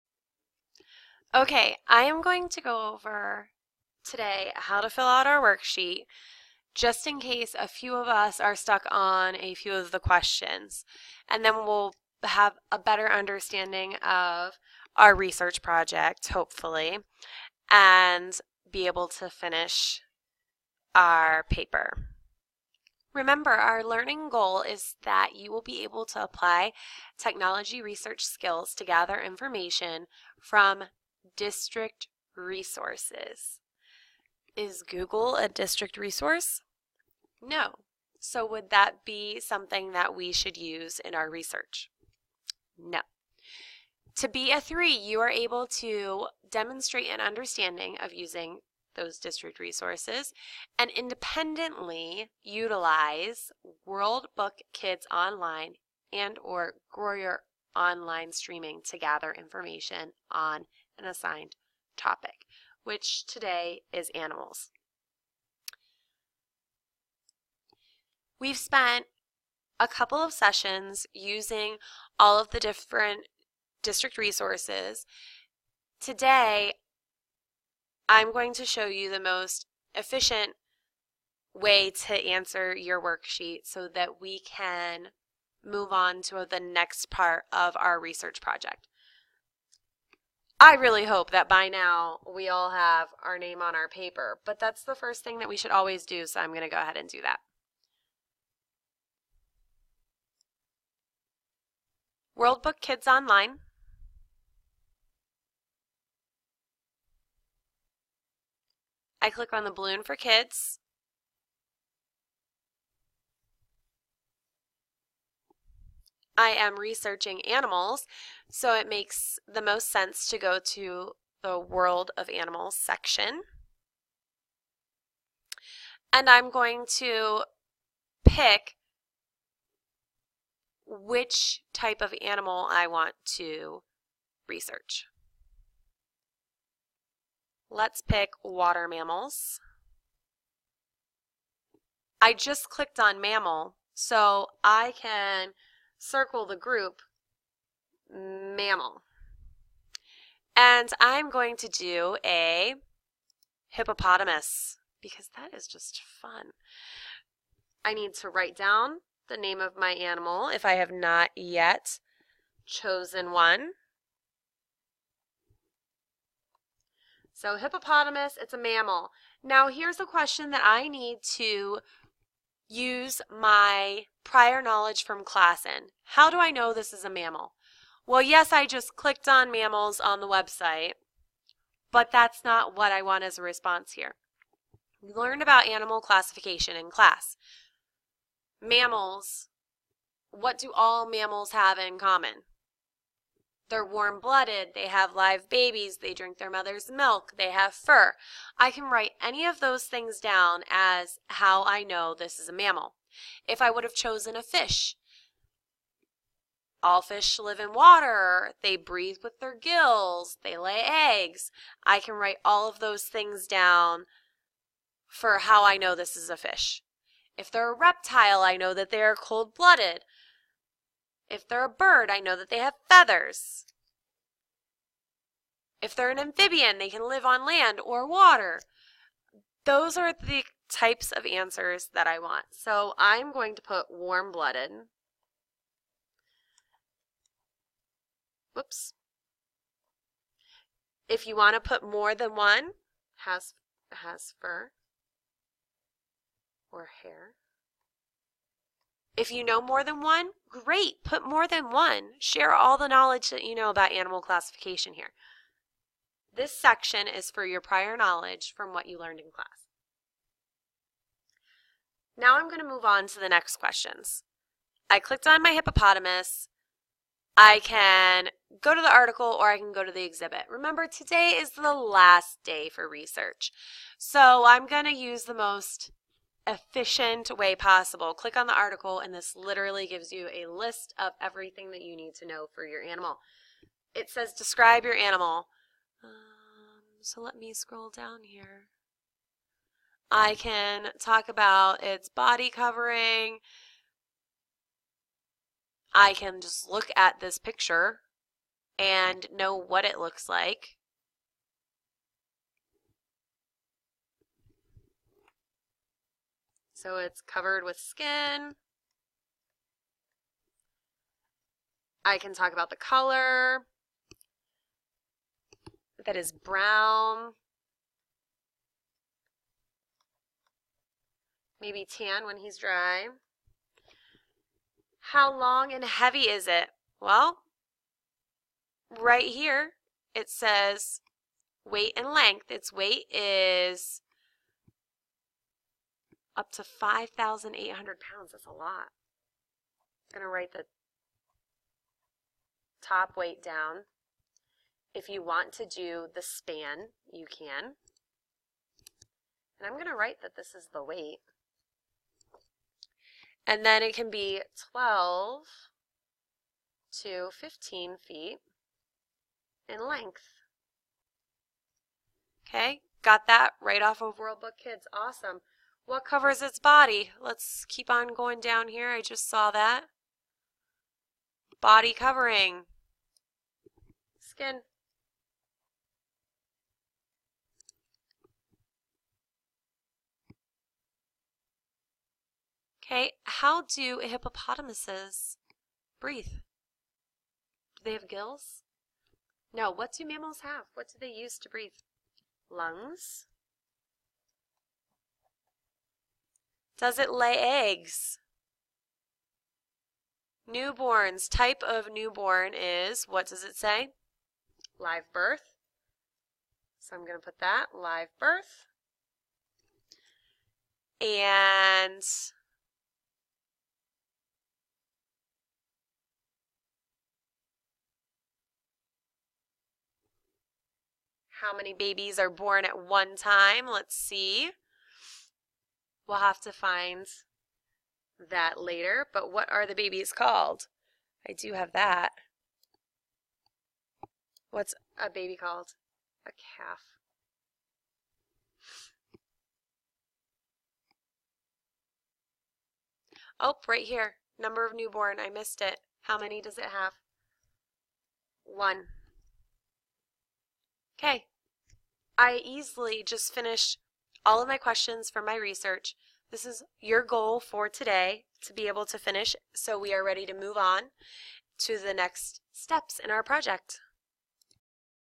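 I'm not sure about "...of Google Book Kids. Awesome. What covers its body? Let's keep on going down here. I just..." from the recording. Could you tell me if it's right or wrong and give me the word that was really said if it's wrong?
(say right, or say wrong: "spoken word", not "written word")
wrong: "World", not "Google".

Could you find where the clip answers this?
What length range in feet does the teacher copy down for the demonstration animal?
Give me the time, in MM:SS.
05:54.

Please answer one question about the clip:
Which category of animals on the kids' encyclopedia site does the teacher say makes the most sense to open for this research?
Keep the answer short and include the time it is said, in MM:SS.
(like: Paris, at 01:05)
World of Animals, at 02:01.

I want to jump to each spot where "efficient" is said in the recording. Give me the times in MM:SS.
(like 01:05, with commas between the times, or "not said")
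01:19, 04:36.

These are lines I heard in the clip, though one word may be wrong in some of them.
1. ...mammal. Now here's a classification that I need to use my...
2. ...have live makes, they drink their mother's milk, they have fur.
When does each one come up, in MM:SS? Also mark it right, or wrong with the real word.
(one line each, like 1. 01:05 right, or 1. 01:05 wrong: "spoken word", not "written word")
1. 02:48 wrong: "question", not "classification"
2. 03:14 wrong: "babies", not "makes".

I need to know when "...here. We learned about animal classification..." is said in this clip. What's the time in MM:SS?
03:03.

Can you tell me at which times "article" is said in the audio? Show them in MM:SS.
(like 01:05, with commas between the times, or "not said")
04:28, 04:38.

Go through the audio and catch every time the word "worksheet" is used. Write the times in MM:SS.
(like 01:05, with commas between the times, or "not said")
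00:05, 01:23.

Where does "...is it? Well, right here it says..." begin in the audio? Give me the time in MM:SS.
05:26.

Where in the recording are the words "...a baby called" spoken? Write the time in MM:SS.
07:15.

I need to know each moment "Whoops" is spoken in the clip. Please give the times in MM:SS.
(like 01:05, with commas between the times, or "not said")
03:58.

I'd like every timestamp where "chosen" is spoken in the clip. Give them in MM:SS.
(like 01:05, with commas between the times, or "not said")
02:42, 03:23.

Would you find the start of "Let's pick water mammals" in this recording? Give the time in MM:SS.
02:17.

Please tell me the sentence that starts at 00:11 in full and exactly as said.
And then we'll have a better understanding of our research project, hopefully, and be able to finish our paper.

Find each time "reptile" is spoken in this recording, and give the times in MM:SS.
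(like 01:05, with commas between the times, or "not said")
03:37.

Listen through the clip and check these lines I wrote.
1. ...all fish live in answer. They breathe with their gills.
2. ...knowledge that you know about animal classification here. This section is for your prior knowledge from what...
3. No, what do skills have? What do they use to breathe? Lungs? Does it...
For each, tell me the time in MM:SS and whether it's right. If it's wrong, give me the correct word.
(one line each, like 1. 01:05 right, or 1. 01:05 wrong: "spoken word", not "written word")
1. 03:26 wrong: "water", not "answer"
2. 04:12 right
3. 06:29 wrong: "mammals", not "skills".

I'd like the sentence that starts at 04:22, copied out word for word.
Now I'm going to move on to the next questions.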